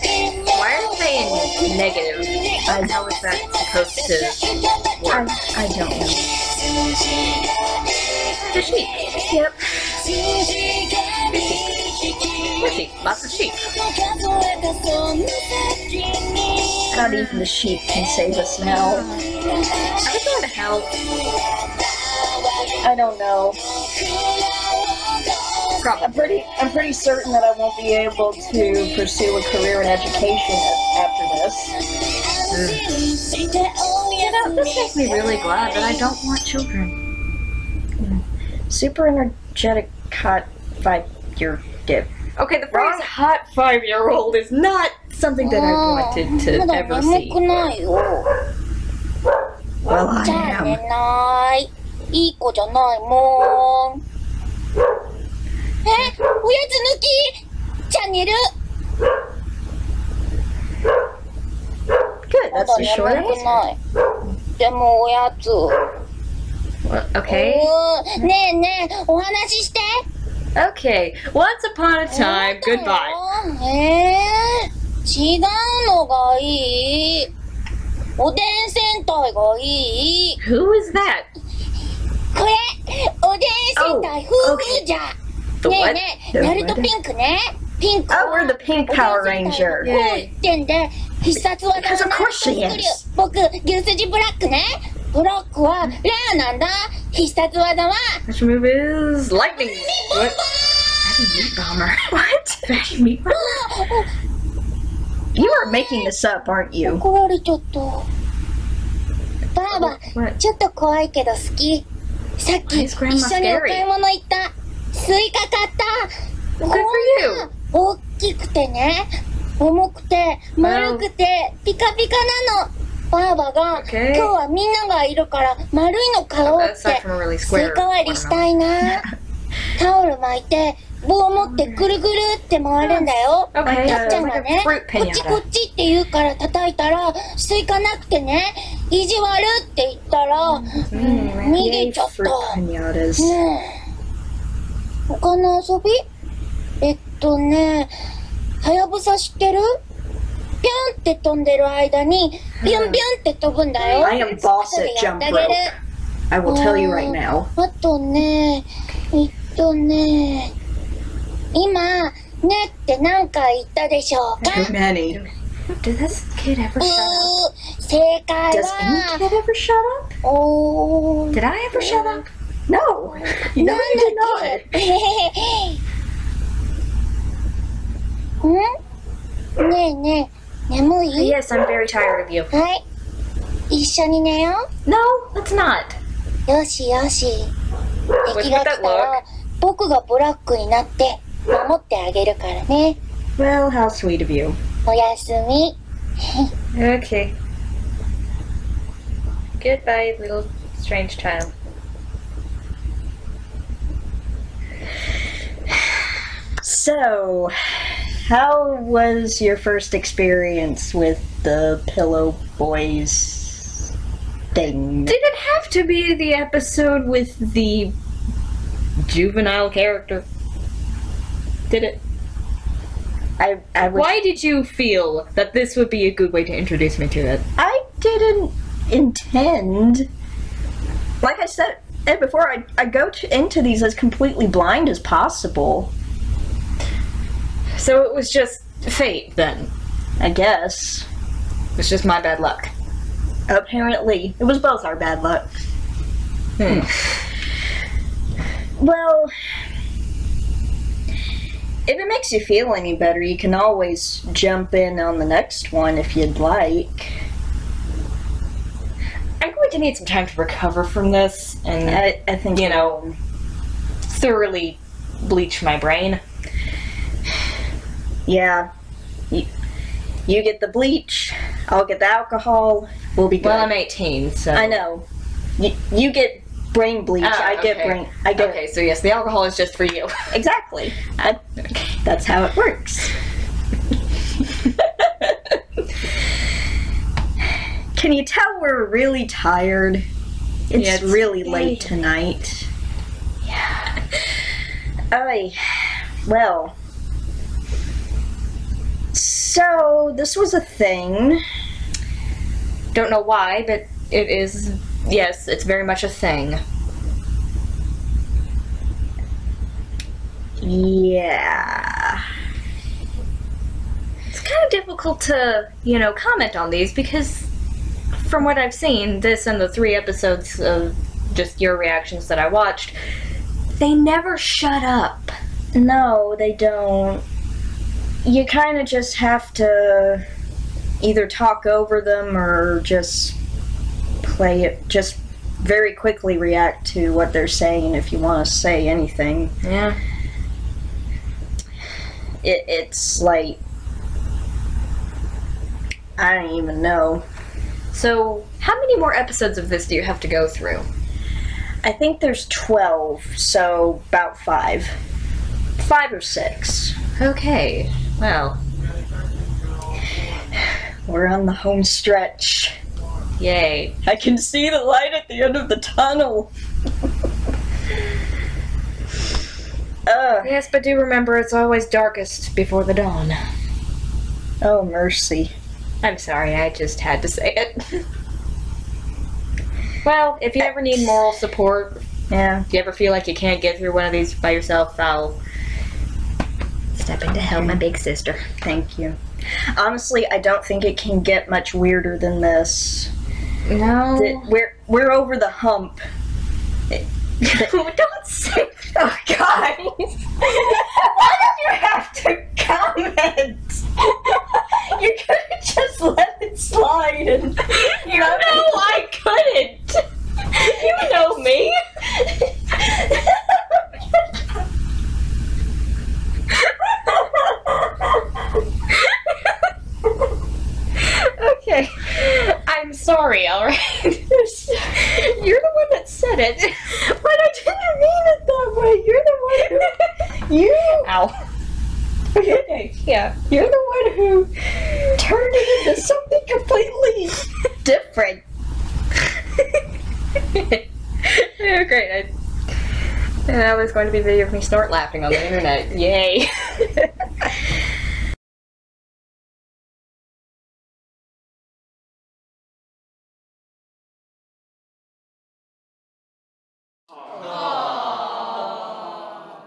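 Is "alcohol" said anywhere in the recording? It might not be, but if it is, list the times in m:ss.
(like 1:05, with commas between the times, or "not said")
4:32, 4:39.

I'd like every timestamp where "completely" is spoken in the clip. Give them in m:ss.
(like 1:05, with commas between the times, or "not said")
3:53, 7:17.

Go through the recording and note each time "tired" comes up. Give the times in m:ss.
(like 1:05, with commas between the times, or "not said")
3:01, 4:49.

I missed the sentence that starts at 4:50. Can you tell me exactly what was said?
It's, yeah, it's really late, late tonight.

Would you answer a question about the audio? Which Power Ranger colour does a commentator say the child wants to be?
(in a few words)
Pink.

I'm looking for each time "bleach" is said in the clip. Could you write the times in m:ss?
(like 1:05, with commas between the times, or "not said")
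4:25, 4:30, 4:37.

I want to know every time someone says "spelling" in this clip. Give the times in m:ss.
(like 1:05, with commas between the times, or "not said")
not said.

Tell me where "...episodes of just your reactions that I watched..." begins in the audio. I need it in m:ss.
5:19.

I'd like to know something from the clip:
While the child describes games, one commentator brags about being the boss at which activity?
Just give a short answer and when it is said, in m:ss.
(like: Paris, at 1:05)
Jump rope, at 2:34.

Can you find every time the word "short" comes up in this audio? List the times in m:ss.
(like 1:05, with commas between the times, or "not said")
1:02.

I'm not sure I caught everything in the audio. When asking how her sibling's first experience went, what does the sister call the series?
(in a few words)
Pillow Boys.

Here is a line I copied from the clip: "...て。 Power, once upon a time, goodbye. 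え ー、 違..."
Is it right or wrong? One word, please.
wrong.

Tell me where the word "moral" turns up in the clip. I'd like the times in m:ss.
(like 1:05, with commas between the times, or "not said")
6:21.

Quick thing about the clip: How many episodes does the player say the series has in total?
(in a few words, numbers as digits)
12.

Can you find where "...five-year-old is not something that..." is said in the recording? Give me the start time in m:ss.
0:43.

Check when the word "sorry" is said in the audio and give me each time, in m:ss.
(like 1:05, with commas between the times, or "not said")
6:16.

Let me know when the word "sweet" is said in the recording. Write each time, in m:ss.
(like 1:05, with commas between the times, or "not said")
3:13.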